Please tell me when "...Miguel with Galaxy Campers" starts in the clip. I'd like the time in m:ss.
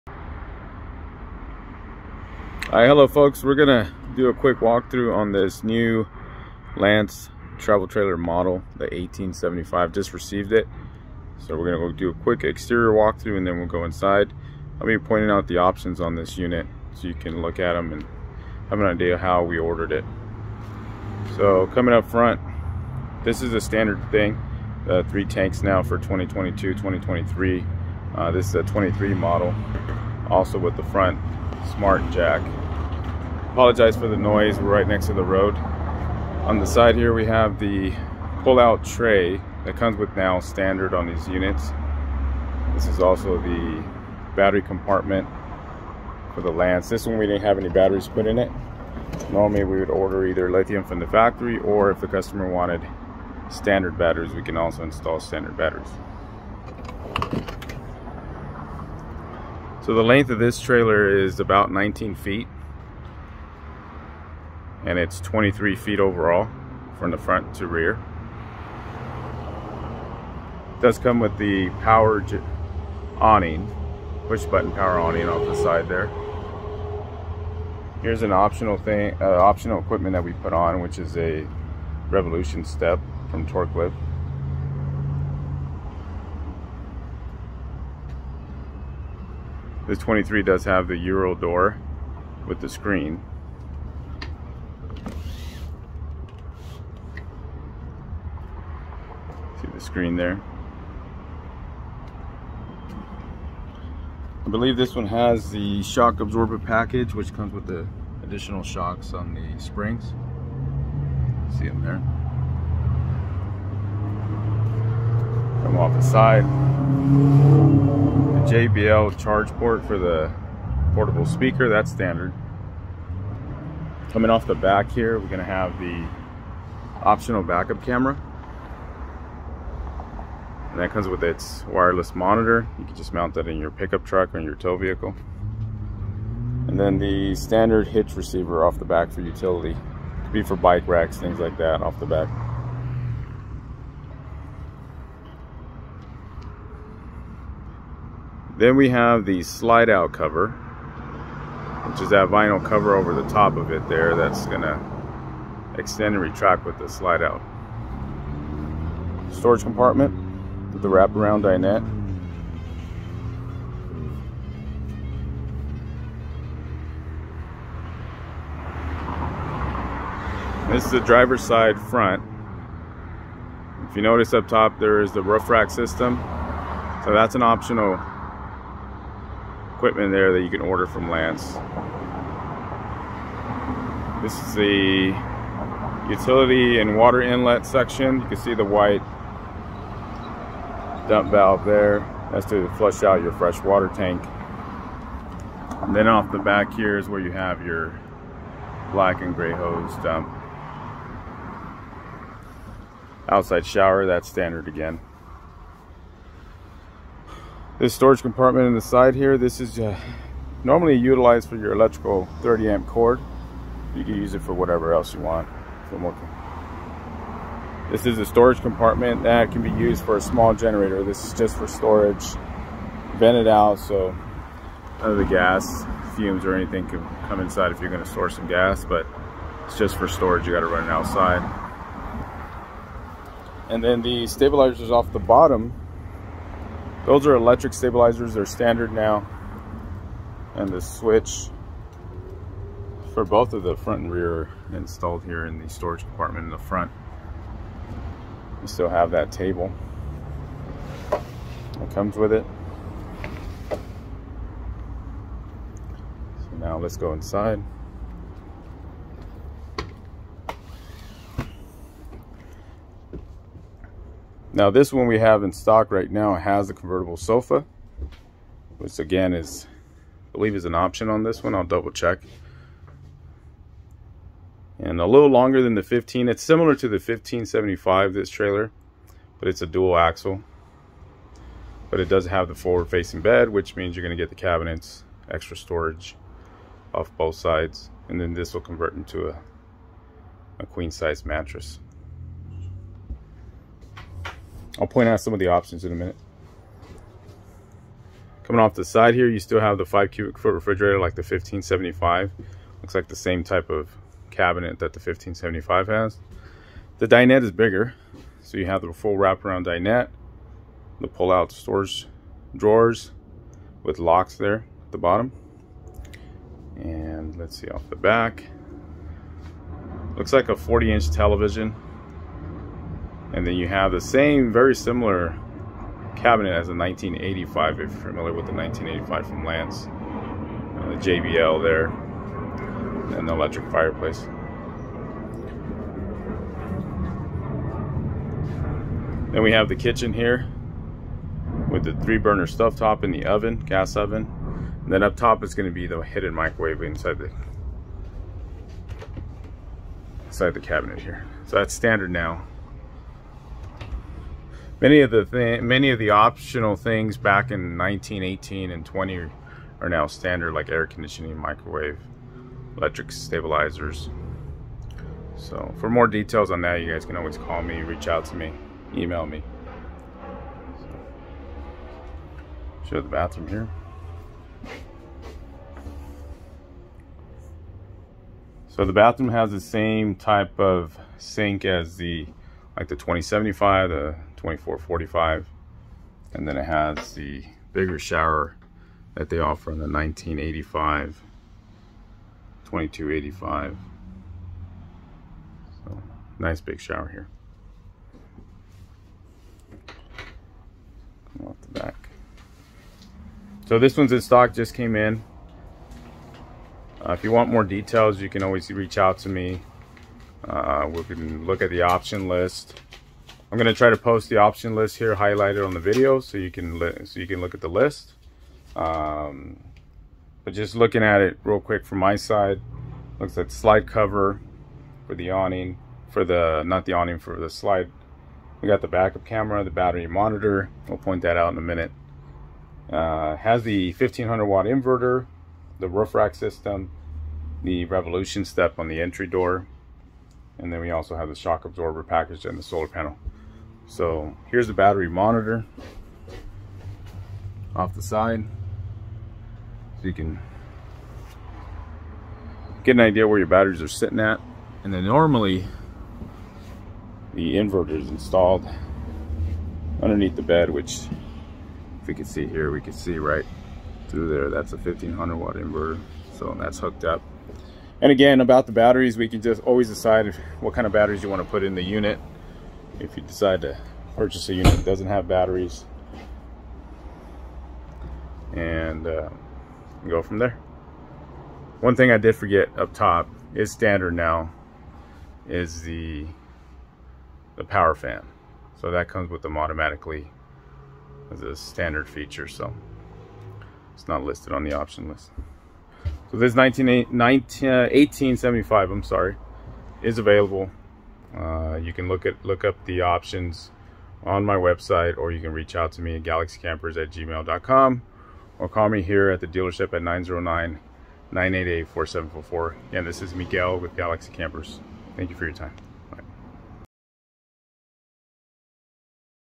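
8:33.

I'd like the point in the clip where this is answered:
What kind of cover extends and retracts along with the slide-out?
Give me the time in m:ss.
2:32.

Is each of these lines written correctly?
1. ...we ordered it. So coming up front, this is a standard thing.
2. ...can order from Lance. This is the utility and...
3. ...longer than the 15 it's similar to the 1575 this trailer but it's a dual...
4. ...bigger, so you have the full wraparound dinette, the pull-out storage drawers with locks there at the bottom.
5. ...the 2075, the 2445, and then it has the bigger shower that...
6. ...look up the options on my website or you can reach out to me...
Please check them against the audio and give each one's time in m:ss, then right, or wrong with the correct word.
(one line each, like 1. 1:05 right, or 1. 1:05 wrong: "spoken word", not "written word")
1. 0:19 right
2. 3:00 right
3. 4:35 right
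4. 5:07 right
5. 6:22 right
6. 8:22 right.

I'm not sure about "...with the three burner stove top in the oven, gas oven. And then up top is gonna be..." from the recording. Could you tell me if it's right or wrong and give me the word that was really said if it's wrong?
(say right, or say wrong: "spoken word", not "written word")
right.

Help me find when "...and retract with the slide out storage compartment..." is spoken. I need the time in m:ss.
2:36.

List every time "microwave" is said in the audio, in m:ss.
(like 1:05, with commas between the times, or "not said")
5:46, 6:01.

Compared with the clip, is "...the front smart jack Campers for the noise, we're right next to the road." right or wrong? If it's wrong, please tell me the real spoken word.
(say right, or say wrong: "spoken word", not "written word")
wrong: "Apologize", not "Campers".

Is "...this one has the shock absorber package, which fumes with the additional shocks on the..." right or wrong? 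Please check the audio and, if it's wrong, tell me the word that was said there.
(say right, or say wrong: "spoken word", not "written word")
wrong: "comes", not "fumes".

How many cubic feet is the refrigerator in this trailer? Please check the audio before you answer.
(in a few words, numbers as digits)
5.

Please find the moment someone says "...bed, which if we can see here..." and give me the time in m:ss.
7:40.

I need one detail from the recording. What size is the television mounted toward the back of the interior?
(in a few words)
40-inch.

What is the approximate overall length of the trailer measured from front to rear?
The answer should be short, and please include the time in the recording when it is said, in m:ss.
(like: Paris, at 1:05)
23 feet, at 1:05.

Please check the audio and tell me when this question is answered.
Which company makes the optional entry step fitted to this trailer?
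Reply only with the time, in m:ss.
1:23.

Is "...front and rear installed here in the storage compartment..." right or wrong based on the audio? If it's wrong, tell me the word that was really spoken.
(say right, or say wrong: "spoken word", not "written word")
right.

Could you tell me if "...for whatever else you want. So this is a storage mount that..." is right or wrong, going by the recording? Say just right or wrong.
wrong.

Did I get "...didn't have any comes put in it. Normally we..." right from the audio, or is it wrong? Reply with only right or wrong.
wrong.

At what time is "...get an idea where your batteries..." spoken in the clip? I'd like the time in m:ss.
7:32.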